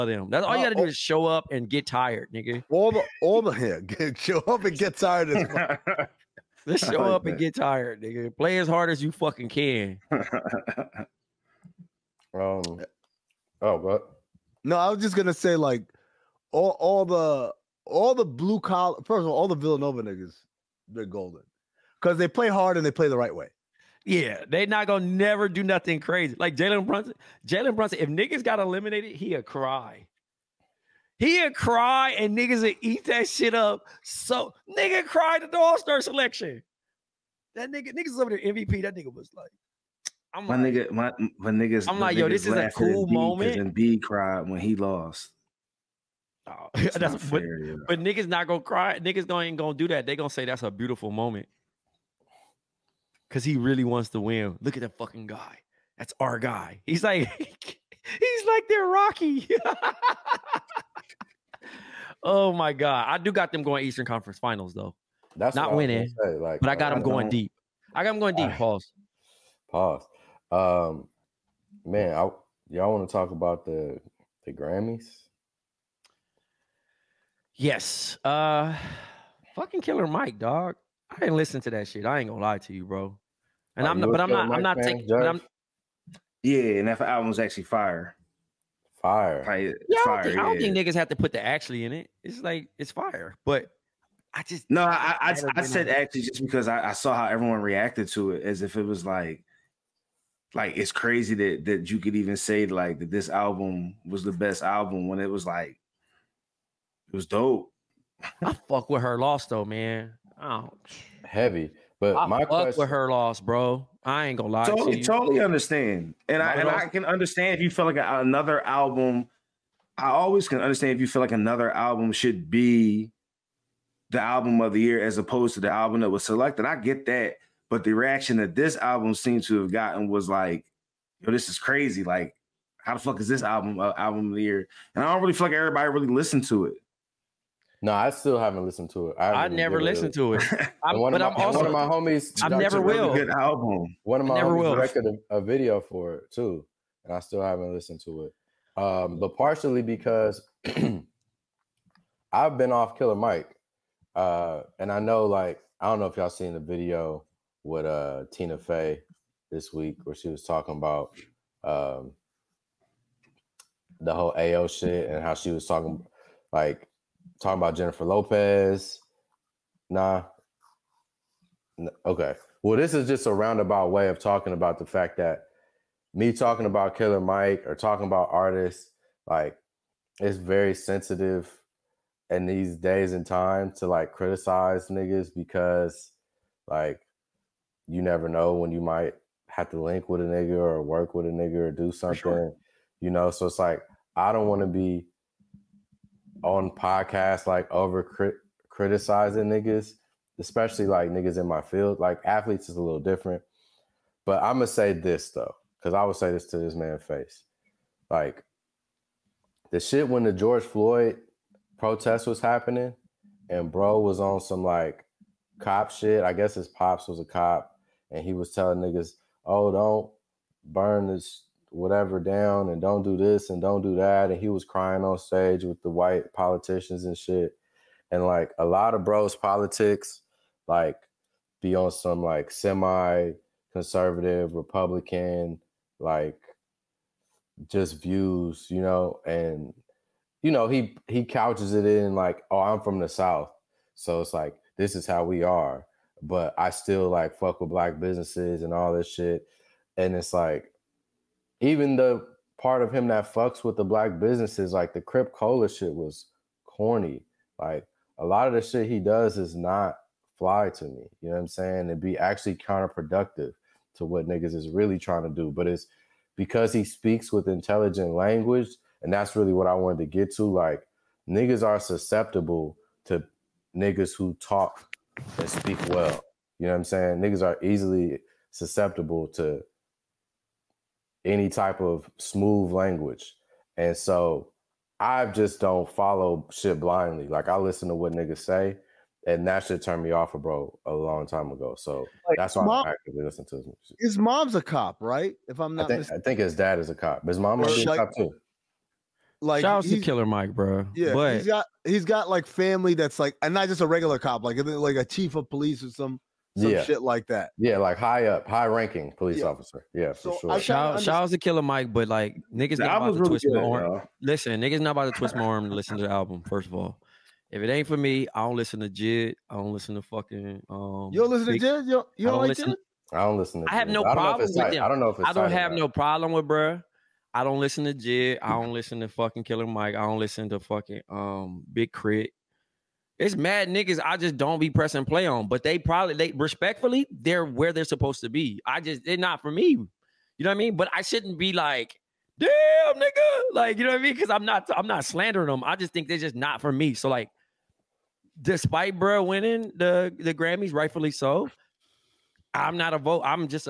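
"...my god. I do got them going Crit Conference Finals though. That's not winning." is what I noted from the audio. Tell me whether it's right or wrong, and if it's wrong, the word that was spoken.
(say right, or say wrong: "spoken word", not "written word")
wrong: "Eastern", not "Crit".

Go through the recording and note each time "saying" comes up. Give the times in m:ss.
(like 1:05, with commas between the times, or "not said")
4:21, 4:36.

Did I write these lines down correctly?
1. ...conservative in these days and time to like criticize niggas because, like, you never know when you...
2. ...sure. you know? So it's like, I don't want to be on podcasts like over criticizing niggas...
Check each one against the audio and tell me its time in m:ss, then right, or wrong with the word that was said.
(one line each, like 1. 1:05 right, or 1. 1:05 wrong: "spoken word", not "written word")
1. 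3:00 wrong: "sensitive", not "conservative"
2. 3:12 right.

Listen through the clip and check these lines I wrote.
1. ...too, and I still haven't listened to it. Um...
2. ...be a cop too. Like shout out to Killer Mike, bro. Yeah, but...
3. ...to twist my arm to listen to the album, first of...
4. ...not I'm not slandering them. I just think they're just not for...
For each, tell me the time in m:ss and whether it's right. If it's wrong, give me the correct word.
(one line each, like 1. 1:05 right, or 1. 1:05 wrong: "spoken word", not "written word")
1. 2:26 right
2. 4:57 right
3. 5:15 right
4. 5:44 right.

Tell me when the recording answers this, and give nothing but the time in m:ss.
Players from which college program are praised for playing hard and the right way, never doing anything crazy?
0:19.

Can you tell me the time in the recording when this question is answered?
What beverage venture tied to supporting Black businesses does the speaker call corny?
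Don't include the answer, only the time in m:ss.
4:15.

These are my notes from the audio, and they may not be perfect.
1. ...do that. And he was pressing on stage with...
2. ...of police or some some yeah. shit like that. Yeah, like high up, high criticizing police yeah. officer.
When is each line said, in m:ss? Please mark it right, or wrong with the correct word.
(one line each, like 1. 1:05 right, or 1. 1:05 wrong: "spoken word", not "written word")
1. 3:43 wrong: "crying", not "pressing"
2. 5:05 wrong: "ranking", not "criticizing".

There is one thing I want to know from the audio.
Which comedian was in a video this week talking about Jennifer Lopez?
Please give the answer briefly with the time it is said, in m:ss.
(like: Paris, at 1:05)
Tina Fey, at 2:38.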